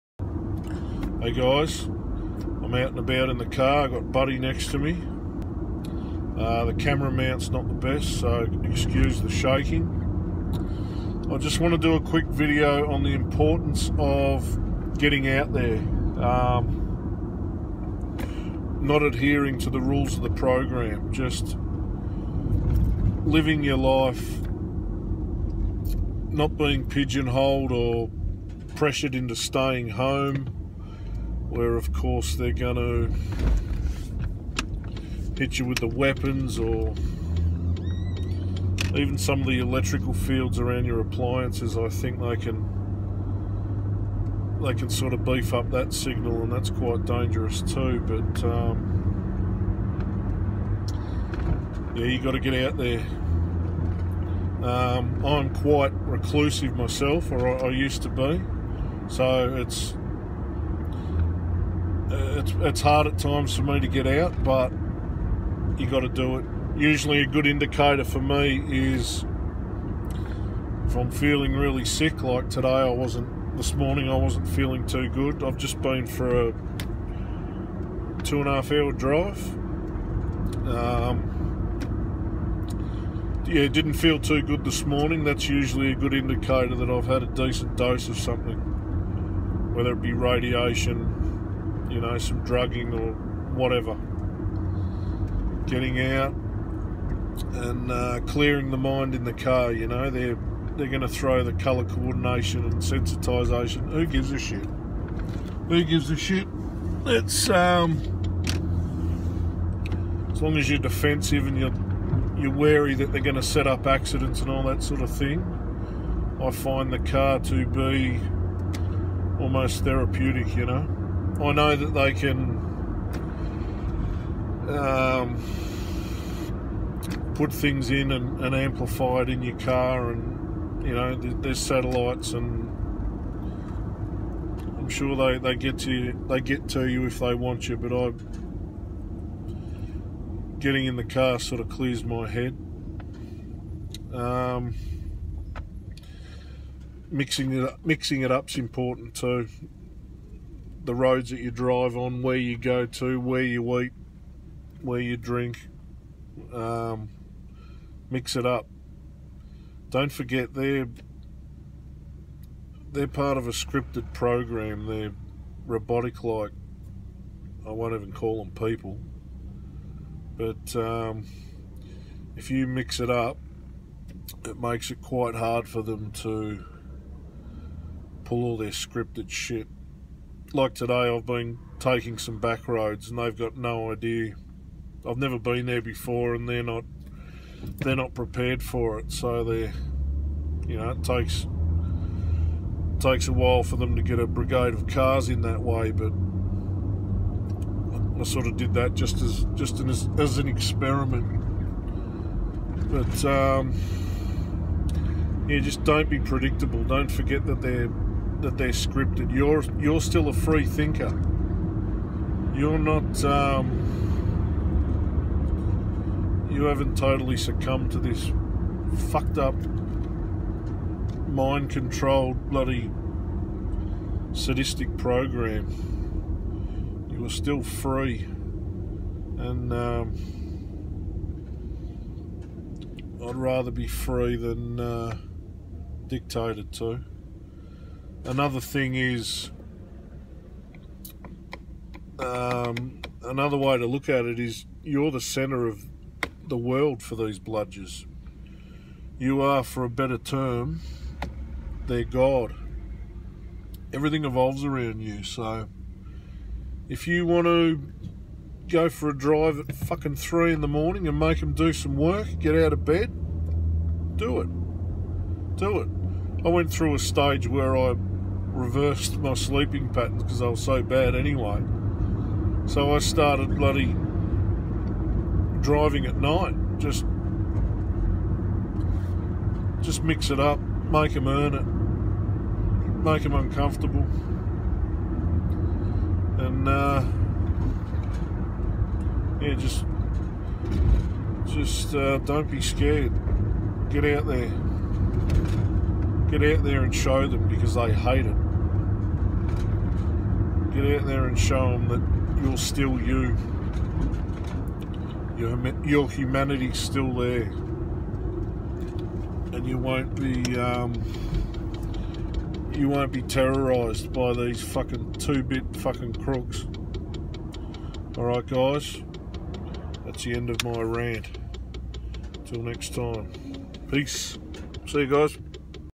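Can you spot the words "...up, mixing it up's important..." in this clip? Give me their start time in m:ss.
2:27.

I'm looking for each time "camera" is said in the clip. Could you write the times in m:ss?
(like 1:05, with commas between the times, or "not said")
0:06.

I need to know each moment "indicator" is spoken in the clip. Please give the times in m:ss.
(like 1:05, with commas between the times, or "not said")
1:07, 1:26.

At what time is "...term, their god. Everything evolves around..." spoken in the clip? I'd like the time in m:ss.
4:10.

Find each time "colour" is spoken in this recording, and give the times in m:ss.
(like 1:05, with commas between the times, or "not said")
1:41.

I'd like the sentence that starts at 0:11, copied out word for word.
I just want to do a quick video on the importance of getting out there.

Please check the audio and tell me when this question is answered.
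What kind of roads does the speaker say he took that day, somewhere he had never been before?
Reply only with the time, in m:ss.
3:02.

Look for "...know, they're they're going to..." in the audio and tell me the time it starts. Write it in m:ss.
1:39.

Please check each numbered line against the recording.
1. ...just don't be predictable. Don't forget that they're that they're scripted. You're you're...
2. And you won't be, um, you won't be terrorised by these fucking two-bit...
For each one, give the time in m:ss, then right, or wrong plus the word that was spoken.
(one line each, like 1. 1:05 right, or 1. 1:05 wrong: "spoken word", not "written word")
1. 3:25 right
2. 5:09 right.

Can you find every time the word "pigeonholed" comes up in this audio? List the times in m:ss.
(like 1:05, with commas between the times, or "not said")
0:26.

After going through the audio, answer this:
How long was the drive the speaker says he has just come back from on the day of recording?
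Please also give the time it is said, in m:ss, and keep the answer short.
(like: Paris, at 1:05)
2.5 hours, at 1:18.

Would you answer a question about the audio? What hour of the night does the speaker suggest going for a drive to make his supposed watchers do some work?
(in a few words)
3 in the morning.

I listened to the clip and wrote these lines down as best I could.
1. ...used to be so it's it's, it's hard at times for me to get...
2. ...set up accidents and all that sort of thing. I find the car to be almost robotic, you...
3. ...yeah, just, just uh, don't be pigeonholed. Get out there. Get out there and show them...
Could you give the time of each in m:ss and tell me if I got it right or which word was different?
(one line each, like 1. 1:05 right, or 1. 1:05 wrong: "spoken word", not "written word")
1. 0:57 right
2. 1:53 wrong: "therapeutic", not "robotic"
3. 4:49 wrong: "scared", not "pigeonholed".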